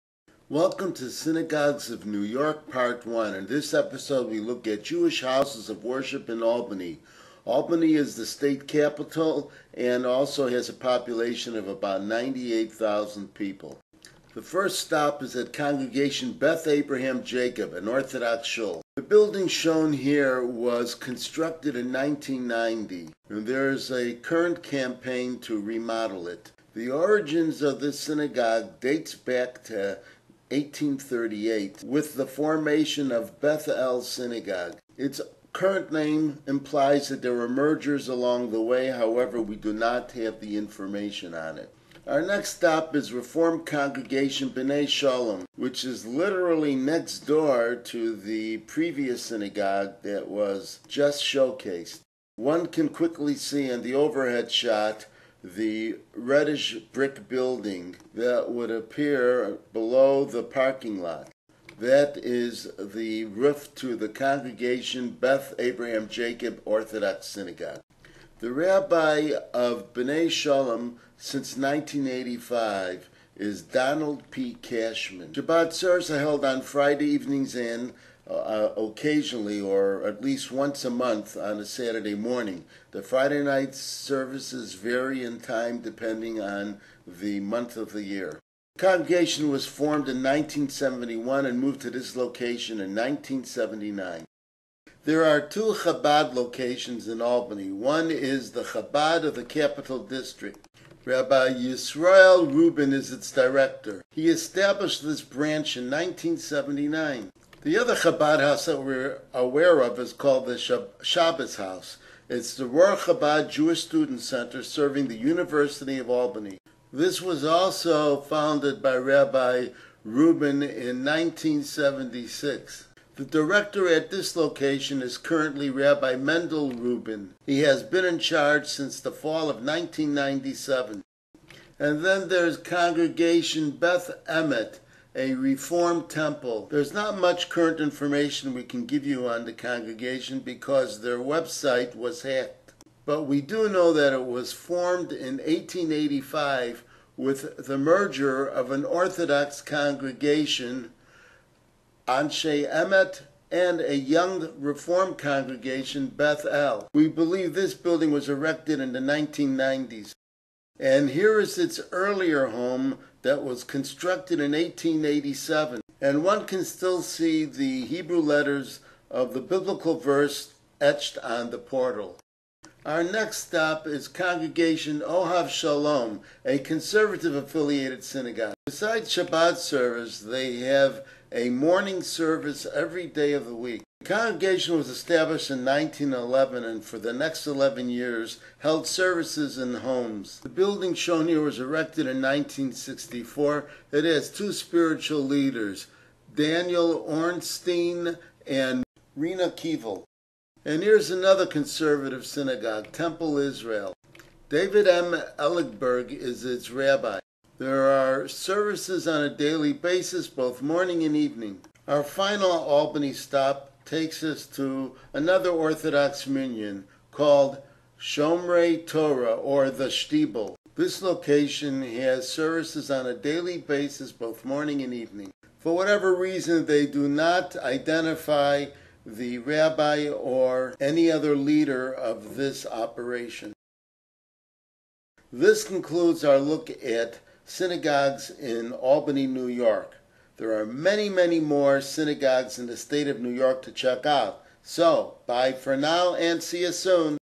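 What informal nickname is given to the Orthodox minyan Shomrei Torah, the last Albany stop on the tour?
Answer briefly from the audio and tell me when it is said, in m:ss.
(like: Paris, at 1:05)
The Shtibel, at 3:39.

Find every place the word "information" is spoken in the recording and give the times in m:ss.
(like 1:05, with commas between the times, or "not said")
0:40, 2:17.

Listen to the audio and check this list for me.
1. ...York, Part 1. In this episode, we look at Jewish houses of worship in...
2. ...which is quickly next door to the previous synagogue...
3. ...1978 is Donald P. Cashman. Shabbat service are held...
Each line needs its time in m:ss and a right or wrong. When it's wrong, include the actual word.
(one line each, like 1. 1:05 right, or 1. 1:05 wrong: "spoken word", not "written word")
1. 0:02 right
2. 0:45 wrong: "literally", not "quickly"
3. 1:11 wrong: "1985", not "1978".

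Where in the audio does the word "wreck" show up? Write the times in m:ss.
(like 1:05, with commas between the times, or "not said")
not said.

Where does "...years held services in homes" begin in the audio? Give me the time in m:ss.
3:07.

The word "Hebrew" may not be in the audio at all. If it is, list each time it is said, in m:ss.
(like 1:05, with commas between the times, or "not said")
2:47.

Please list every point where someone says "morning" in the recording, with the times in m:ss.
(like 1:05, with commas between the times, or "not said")
1:22, 3:01, 3:30, 3:44.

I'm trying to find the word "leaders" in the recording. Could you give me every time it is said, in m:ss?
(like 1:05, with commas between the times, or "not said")
3:15, 3:51.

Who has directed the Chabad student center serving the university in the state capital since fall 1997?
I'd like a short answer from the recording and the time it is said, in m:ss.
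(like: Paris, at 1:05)
Rabbi Mendel Rubin, at 2:05.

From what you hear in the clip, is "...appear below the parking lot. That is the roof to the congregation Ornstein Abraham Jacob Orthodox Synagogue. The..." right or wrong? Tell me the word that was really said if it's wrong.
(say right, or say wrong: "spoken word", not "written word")
wrong: "Beth", not "Ornstein".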